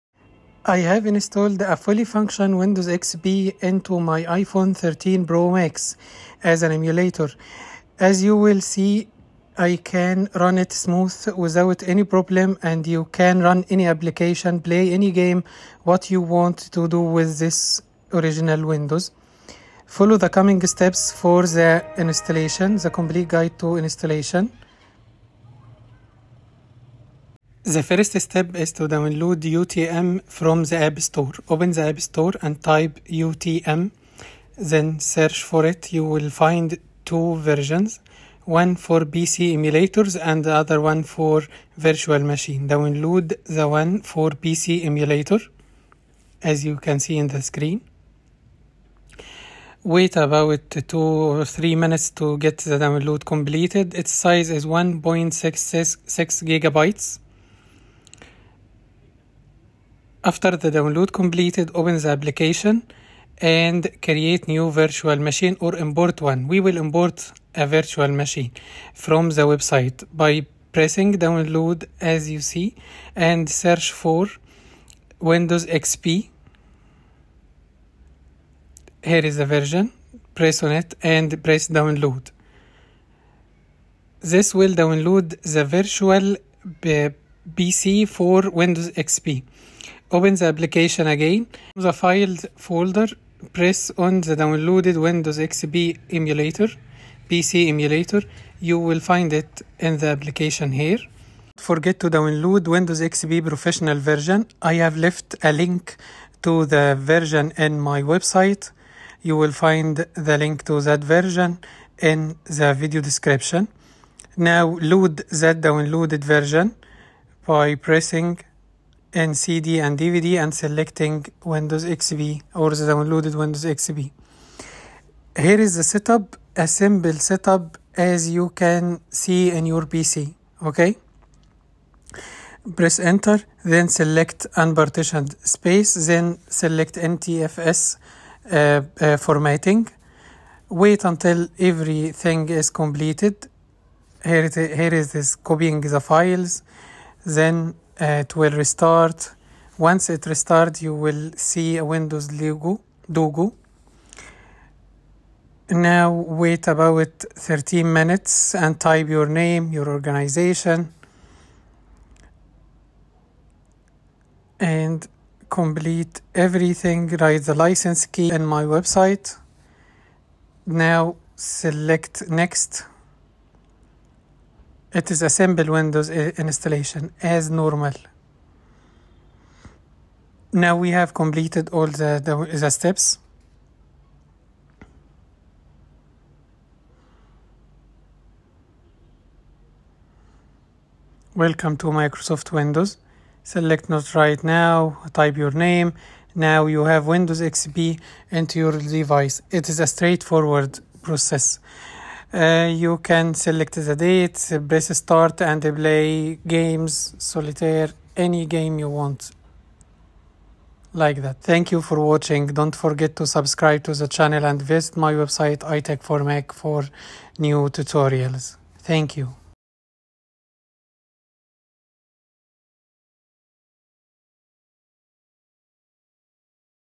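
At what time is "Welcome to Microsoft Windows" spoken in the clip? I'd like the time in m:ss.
3:11.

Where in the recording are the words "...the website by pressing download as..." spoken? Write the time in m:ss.
1:09.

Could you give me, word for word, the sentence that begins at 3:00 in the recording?
Now we have completed all the, the, the steps.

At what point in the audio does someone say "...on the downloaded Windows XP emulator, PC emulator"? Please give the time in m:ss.
1:33.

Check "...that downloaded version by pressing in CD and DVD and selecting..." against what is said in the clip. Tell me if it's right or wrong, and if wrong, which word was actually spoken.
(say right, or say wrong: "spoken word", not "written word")
right.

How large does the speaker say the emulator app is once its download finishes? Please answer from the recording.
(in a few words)
1.66 gigabytes.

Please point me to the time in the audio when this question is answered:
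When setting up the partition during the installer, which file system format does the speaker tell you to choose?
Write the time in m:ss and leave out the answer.
2:16.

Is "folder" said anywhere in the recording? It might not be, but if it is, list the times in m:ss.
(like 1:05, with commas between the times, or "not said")
1:32.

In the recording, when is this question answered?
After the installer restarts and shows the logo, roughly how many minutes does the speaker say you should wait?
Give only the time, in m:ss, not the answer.
2:37.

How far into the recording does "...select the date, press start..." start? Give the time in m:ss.
3:23.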